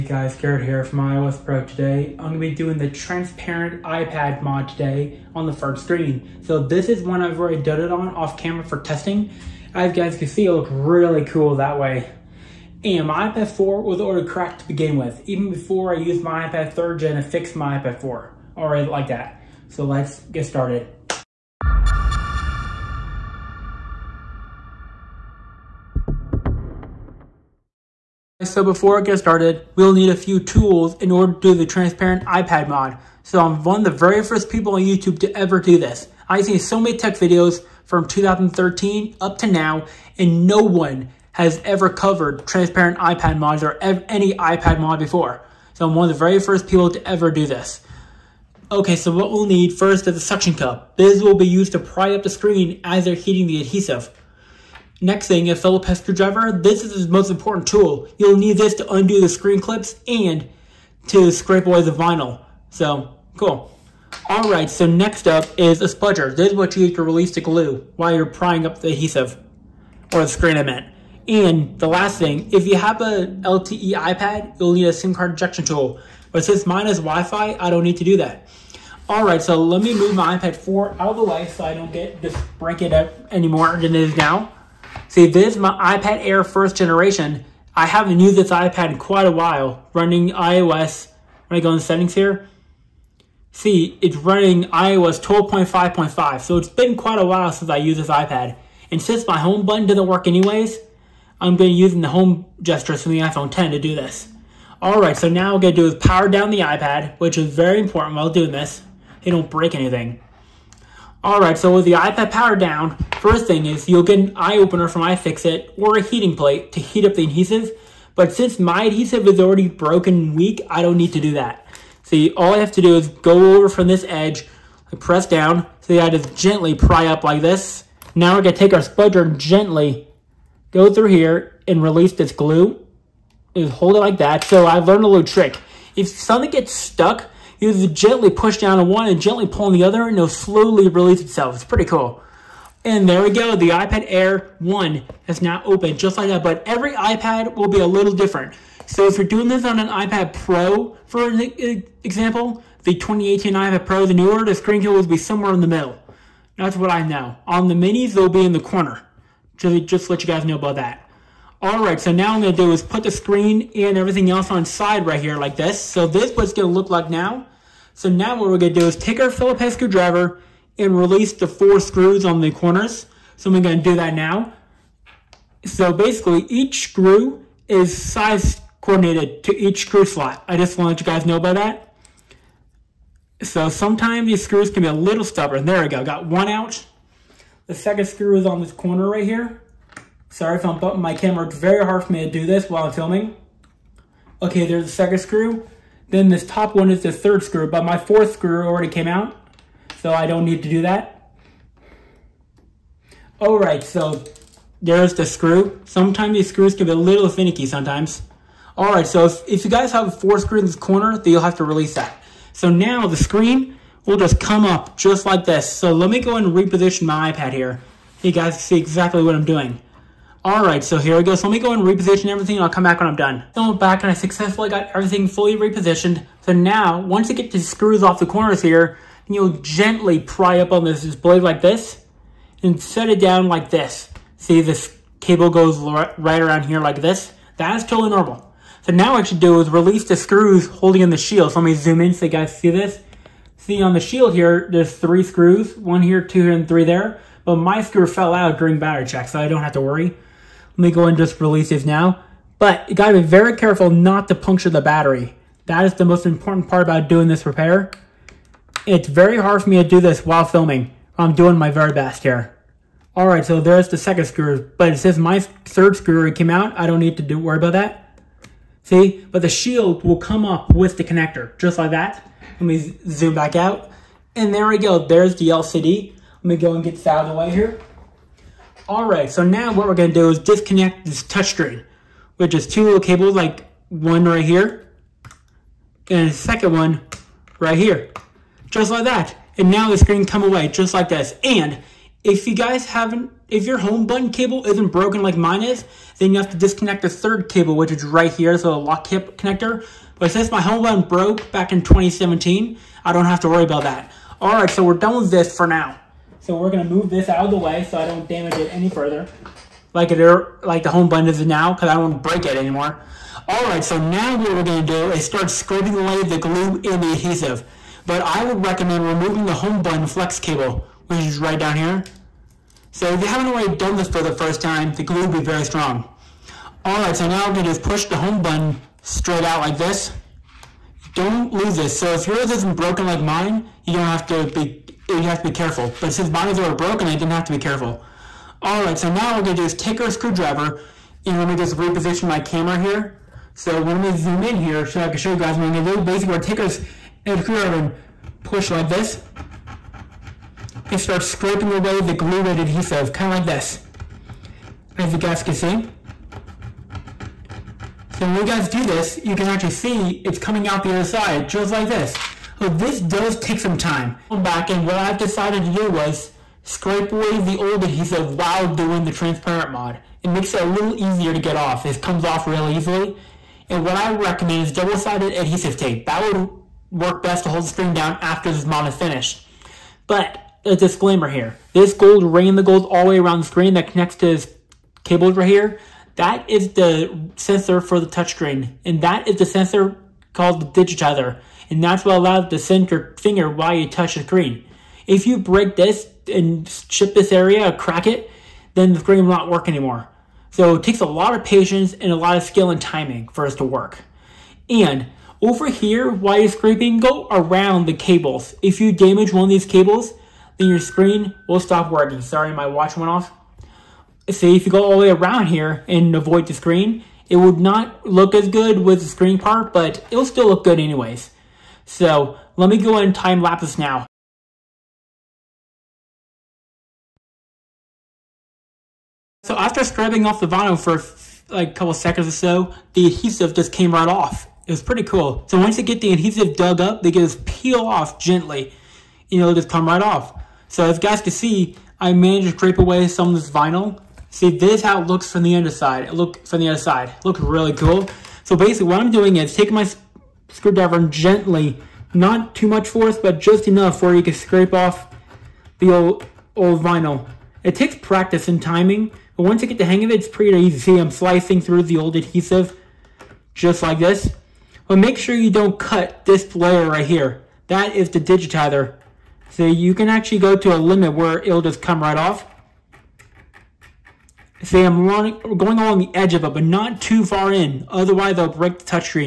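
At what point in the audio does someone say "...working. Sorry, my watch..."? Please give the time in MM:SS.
06:51.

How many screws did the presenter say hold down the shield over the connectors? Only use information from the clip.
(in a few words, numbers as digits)
3.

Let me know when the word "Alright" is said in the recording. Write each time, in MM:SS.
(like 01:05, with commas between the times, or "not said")
01:04, 01:19, 01:44, 04:23.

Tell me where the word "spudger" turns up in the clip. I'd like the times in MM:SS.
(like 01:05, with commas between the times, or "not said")
01:05, 02:08.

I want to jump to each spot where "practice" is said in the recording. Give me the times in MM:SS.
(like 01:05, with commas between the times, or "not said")
07:37.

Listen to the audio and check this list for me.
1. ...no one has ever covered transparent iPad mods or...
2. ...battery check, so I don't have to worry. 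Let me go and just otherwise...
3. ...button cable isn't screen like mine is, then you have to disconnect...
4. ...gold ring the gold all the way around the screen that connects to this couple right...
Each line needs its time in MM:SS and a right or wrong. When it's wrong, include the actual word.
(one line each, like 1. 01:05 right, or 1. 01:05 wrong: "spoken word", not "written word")
1. 00:40 right
2. 04:08 wrong: "release", not "otherwise"
3. 04:54 wrong: "broken", not "screen"
4. 06:21 wrong: "cable", not "couple".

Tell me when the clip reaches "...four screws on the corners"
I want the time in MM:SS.
02:51.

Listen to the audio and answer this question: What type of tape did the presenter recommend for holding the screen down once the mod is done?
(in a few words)
Double-sided adhesive tape.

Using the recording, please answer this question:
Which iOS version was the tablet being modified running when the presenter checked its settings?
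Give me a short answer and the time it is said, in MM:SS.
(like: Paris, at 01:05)
iOS 12.5.5, at 01:34.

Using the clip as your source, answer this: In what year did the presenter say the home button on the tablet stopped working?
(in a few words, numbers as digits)
2017.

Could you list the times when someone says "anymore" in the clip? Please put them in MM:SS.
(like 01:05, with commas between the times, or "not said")
01:23, 05:12, 06:39.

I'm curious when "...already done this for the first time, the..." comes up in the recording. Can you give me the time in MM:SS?
05:23.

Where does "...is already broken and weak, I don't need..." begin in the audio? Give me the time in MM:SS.
01:59.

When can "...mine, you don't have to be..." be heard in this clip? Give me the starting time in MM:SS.
05:33.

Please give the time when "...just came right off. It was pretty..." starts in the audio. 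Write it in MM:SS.
07:13.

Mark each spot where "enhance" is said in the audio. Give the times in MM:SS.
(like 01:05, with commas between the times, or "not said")
not said.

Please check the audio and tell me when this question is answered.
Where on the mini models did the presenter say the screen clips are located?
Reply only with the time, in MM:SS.
02:38.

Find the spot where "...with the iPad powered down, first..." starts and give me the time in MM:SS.
01:51.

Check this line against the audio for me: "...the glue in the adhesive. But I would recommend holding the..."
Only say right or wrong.
wrong.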